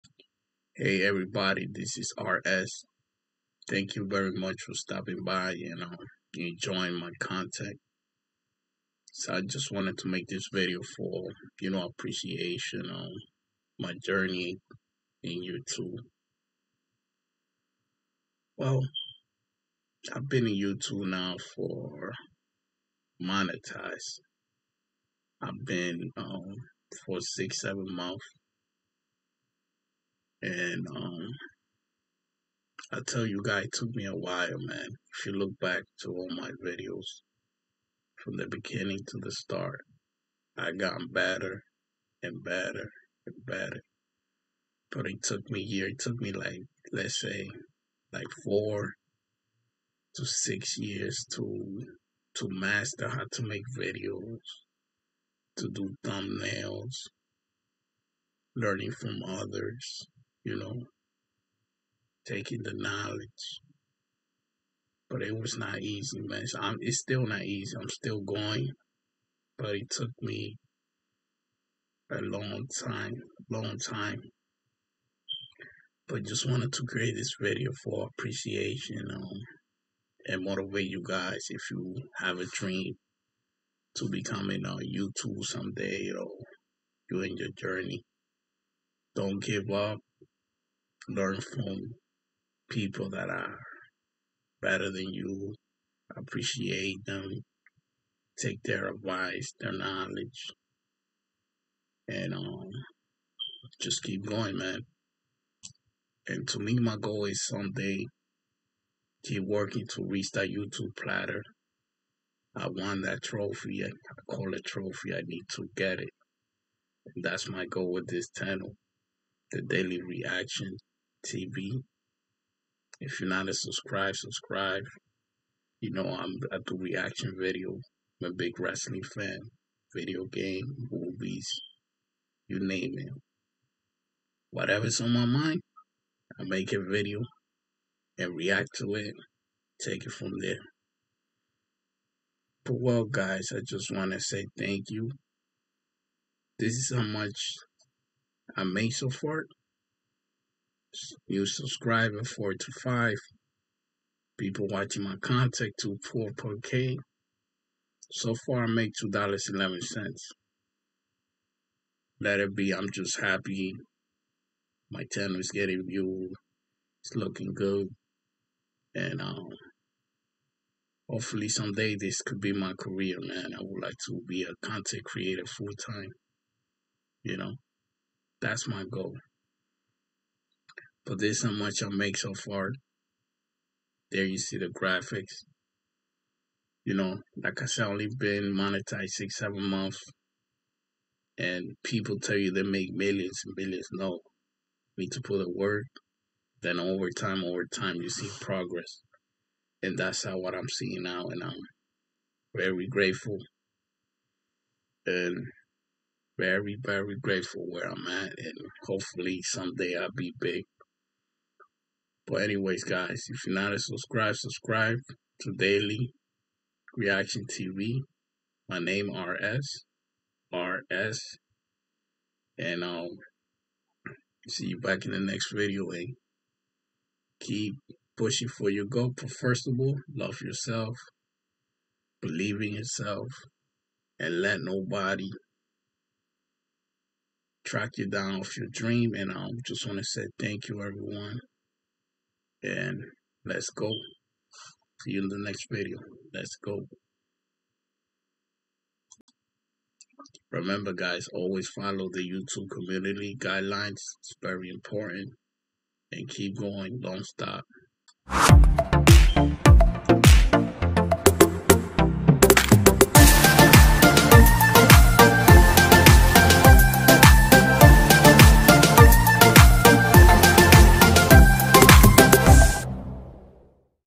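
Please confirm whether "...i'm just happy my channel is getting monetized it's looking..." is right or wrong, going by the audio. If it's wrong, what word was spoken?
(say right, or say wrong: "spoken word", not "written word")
wrong: "viewed", not "monetized".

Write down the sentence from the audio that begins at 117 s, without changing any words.
And that's my goal with this channel, the daily reaction TV.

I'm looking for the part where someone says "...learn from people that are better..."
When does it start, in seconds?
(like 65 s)
91 s.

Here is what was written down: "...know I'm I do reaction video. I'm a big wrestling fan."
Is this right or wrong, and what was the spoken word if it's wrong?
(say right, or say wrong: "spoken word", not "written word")
right.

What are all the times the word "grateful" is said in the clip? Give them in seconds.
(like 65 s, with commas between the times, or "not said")
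202 s, 207 s.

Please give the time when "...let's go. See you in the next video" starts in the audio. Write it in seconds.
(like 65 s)
243 s.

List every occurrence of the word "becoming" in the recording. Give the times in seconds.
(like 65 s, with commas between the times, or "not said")
84 s.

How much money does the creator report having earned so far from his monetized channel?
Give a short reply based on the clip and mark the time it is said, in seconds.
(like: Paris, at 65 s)
$2.11, at 158 s.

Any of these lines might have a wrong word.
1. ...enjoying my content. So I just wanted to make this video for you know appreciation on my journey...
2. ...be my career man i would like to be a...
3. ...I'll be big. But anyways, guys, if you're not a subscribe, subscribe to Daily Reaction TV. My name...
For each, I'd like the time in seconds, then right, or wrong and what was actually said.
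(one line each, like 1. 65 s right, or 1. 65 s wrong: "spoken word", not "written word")
1. 6 s right
2. 172 s right
3. 209 s right.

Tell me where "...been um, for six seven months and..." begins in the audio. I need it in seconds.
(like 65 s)
25 s.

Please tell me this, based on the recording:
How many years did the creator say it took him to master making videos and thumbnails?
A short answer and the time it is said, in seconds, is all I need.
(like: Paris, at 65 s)
4 to 6 years, at 48 s.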